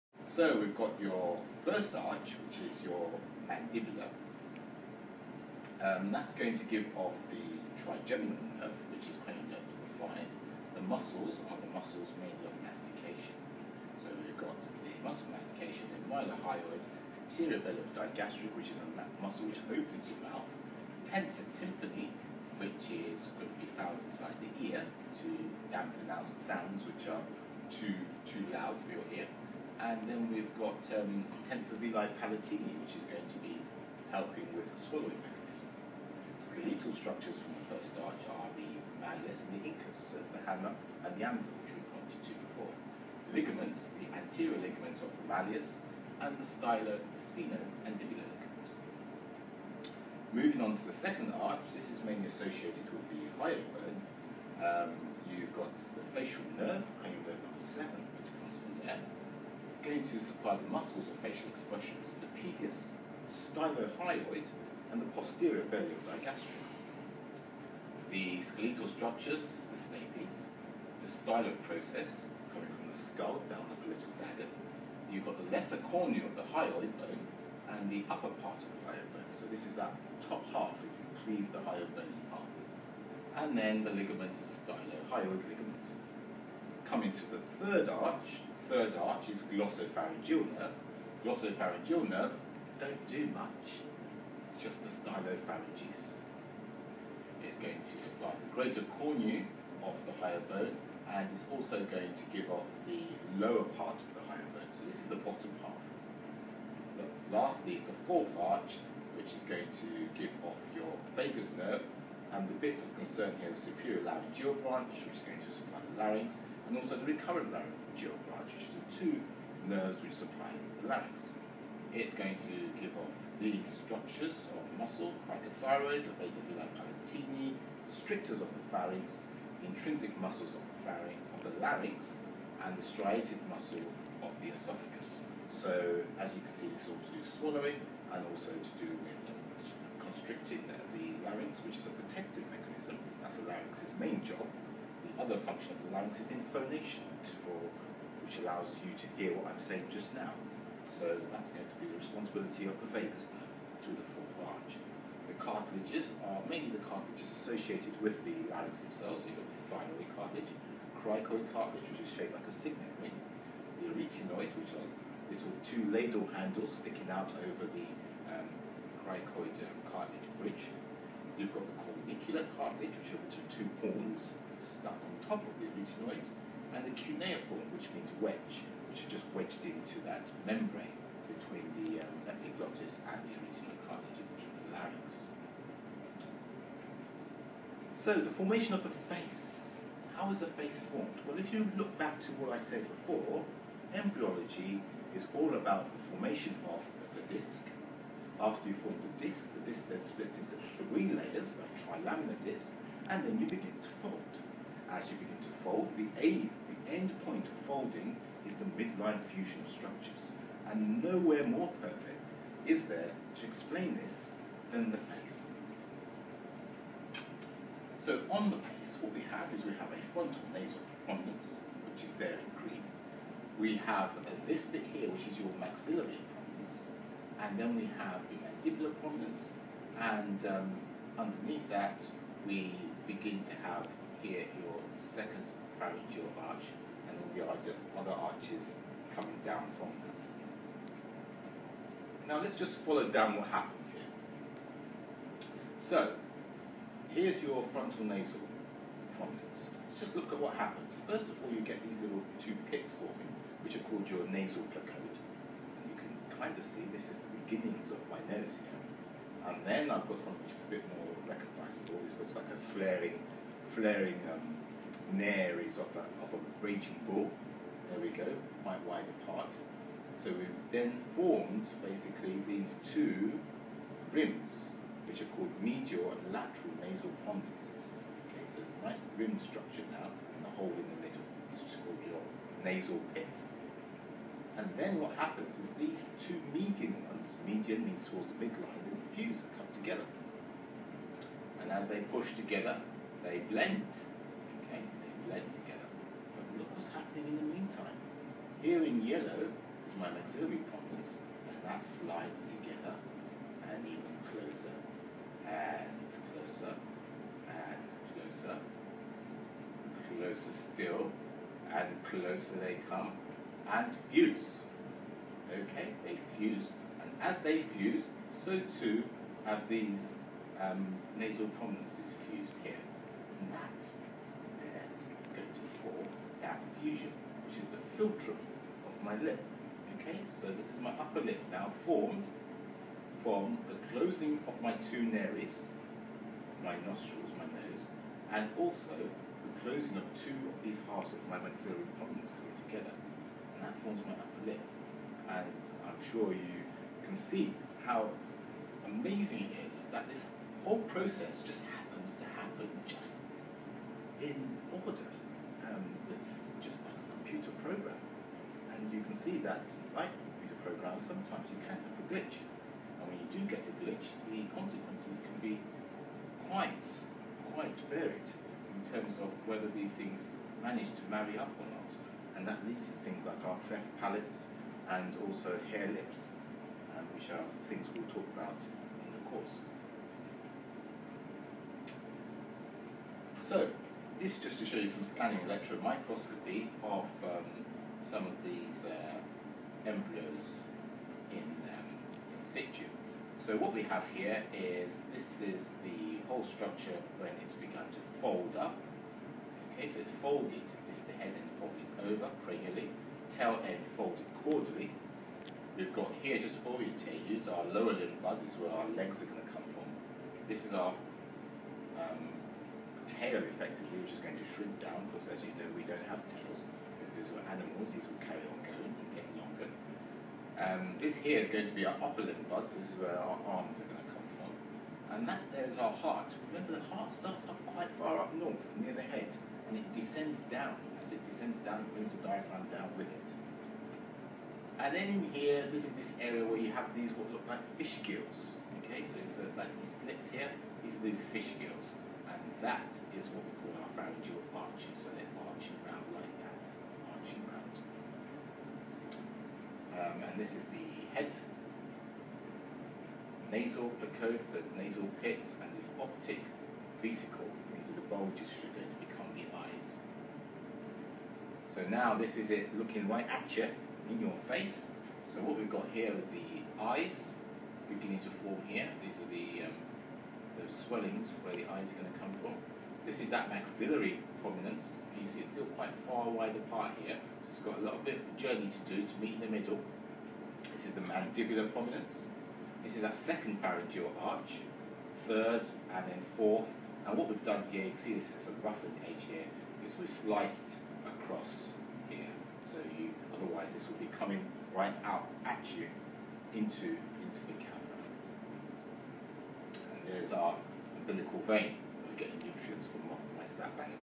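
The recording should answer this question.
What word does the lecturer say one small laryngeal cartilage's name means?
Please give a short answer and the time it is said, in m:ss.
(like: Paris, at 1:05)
Wedge, at 2:58.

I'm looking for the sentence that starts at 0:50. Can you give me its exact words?
Moving on to the second arch, this is mainly associated with the hyoid bone.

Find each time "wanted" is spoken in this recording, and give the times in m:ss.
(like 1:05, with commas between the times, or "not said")
not said.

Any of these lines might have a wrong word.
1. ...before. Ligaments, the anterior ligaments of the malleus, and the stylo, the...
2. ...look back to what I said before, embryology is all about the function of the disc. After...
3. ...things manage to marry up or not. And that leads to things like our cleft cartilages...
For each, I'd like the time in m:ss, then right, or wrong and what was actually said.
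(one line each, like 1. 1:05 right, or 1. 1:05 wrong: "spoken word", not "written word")
1. 0:42 right
2. 3:11 wrong: "formation", not "function"
3. 6:09 wrong: "palates", not "cartilages".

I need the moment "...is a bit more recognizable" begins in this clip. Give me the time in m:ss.
4:20.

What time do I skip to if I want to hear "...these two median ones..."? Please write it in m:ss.
4:45.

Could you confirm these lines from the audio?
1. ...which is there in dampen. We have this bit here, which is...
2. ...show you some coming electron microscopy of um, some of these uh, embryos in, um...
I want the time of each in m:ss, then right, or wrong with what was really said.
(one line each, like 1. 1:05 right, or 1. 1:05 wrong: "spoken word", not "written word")
1. 3:41 wrong: "green", not "dampen"
2. 6:24 wrong: "scanning", not "coming".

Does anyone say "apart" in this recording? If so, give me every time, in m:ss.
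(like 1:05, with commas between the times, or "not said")
4:29, 7:56.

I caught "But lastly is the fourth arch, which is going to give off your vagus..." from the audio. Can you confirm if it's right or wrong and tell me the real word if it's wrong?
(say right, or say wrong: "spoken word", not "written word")
right.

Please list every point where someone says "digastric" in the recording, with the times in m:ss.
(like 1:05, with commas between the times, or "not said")
0:17, 1:06.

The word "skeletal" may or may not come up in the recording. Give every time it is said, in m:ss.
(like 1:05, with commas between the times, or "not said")
0:36, 1:08.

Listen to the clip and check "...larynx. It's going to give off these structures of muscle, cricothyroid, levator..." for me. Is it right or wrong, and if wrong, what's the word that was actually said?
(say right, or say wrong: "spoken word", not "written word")
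right.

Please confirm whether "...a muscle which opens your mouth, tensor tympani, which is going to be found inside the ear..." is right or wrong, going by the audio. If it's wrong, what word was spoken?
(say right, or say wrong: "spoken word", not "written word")
right.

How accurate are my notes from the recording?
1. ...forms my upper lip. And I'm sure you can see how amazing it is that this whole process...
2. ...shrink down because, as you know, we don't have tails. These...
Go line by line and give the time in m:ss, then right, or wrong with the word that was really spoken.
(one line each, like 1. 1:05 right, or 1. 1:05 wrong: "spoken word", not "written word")
1. 5:43 right
2. 6:54 right.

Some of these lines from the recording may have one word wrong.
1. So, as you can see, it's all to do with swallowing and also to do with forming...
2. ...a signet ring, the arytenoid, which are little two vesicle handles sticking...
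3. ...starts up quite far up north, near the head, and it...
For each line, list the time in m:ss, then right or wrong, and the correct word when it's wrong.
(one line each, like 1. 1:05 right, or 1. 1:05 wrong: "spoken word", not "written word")
1. 2:15 wrong: "constricting", not "forming"
2. 2:42 wrong: "ladle", not "vesicle"
3. 7:07 right.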